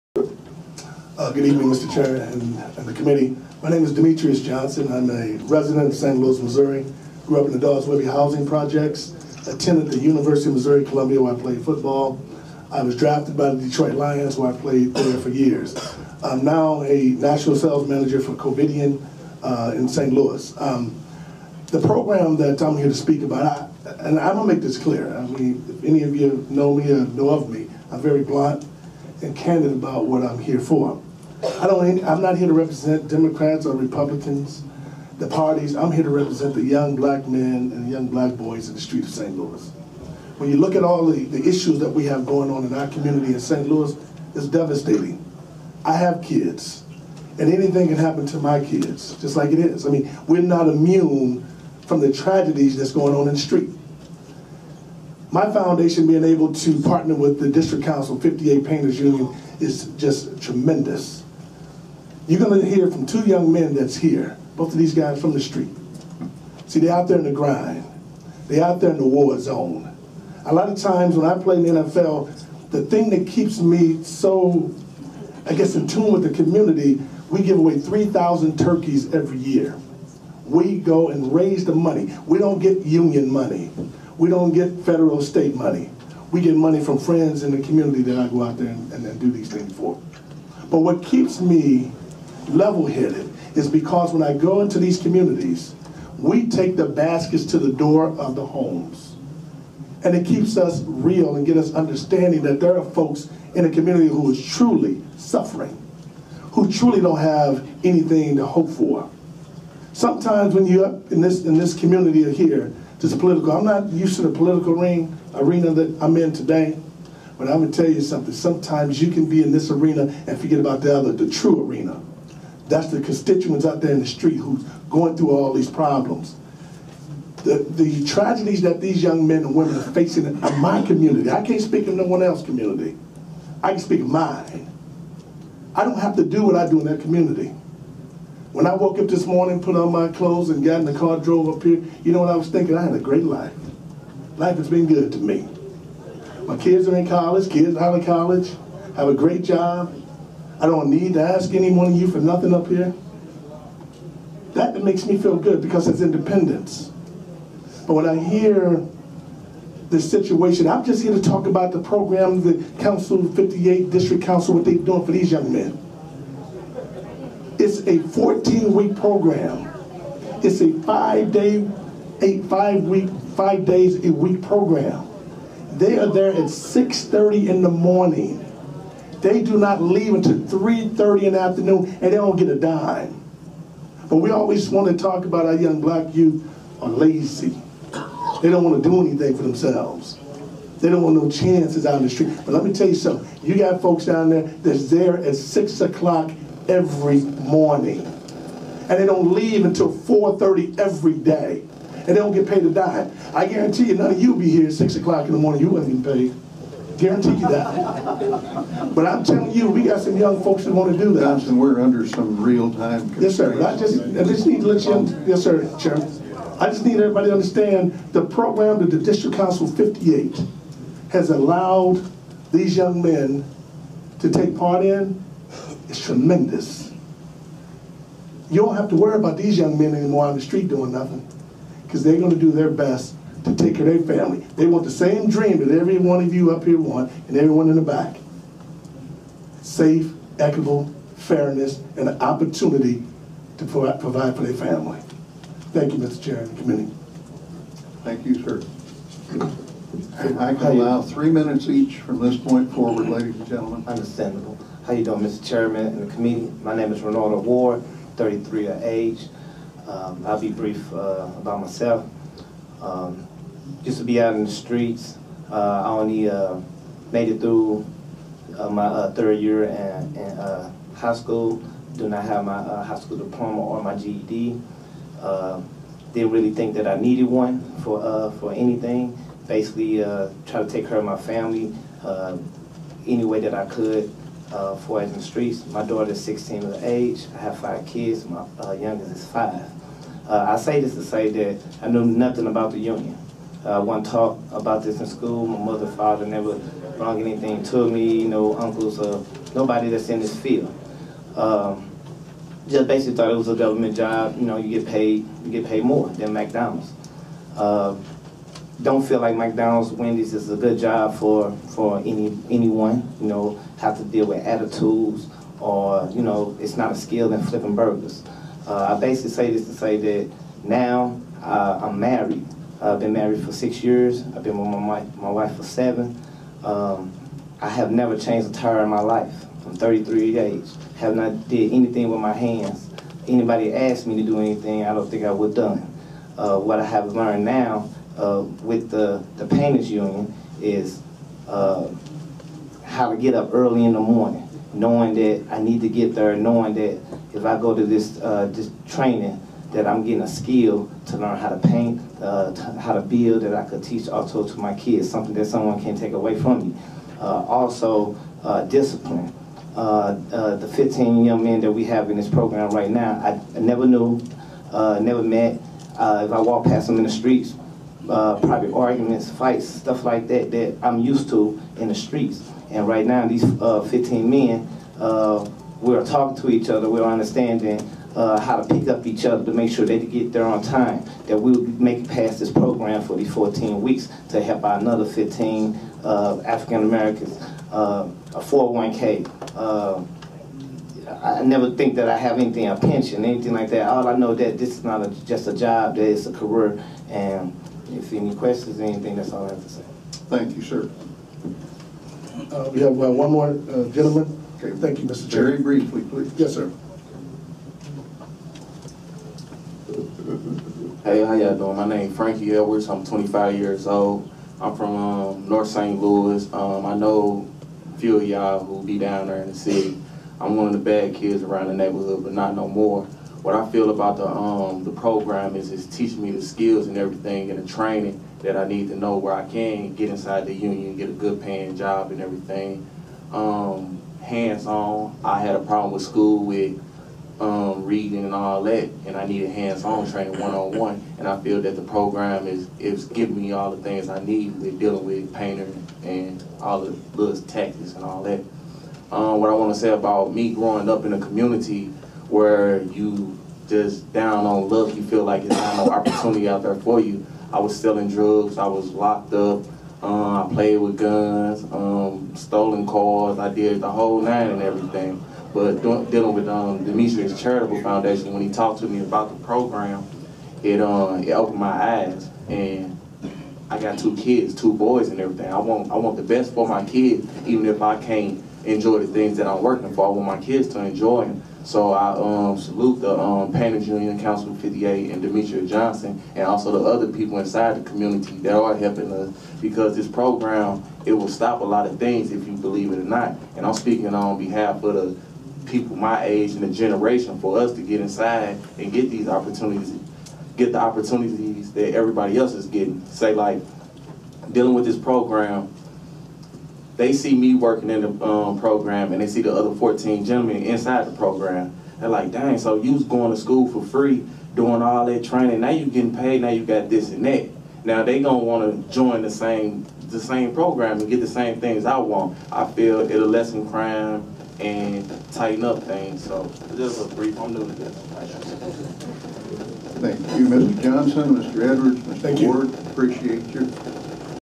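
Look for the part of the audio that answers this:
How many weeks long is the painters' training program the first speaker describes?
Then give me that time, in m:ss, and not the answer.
2:48.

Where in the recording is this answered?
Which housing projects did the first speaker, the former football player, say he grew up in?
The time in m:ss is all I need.
0:07.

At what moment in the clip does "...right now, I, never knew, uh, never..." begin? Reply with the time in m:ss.
6:02.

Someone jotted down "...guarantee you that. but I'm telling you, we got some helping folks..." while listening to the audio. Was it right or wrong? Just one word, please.
wrong.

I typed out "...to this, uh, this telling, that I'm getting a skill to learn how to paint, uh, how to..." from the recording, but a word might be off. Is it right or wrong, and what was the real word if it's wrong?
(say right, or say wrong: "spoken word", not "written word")
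wrong: "training", not "telling".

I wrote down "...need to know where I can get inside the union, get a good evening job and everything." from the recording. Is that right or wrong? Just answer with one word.
wrong.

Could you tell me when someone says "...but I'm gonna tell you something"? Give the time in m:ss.
1:57.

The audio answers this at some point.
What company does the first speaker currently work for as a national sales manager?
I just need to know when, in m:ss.
0:18.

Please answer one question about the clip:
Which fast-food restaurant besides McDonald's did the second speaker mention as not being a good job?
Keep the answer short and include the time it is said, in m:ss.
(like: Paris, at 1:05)
Wendy's, at 5:09.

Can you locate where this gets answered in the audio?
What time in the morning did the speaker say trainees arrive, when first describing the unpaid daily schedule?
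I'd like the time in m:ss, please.
2:56.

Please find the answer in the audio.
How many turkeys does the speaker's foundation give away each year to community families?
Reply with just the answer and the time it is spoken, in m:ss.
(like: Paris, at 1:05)
3,000, at 1:17.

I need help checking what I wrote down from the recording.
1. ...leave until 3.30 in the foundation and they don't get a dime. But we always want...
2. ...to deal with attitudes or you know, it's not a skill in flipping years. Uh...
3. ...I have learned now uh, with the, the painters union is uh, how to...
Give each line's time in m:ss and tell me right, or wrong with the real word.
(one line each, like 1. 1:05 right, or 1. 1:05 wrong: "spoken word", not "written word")
1. 2:59 wrong: "afternoon", not "foundation"
2. 5:13 wrong: "burgers", not "years"
3. 5:36 right.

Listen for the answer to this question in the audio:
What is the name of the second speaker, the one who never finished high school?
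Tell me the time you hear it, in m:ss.
4:17.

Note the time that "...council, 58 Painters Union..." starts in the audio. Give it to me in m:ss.
0:57.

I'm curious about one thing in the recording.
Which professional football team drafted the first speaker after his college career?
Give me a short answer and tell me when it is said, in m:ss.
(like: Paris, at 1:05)
Detroit Lions, at 0:13.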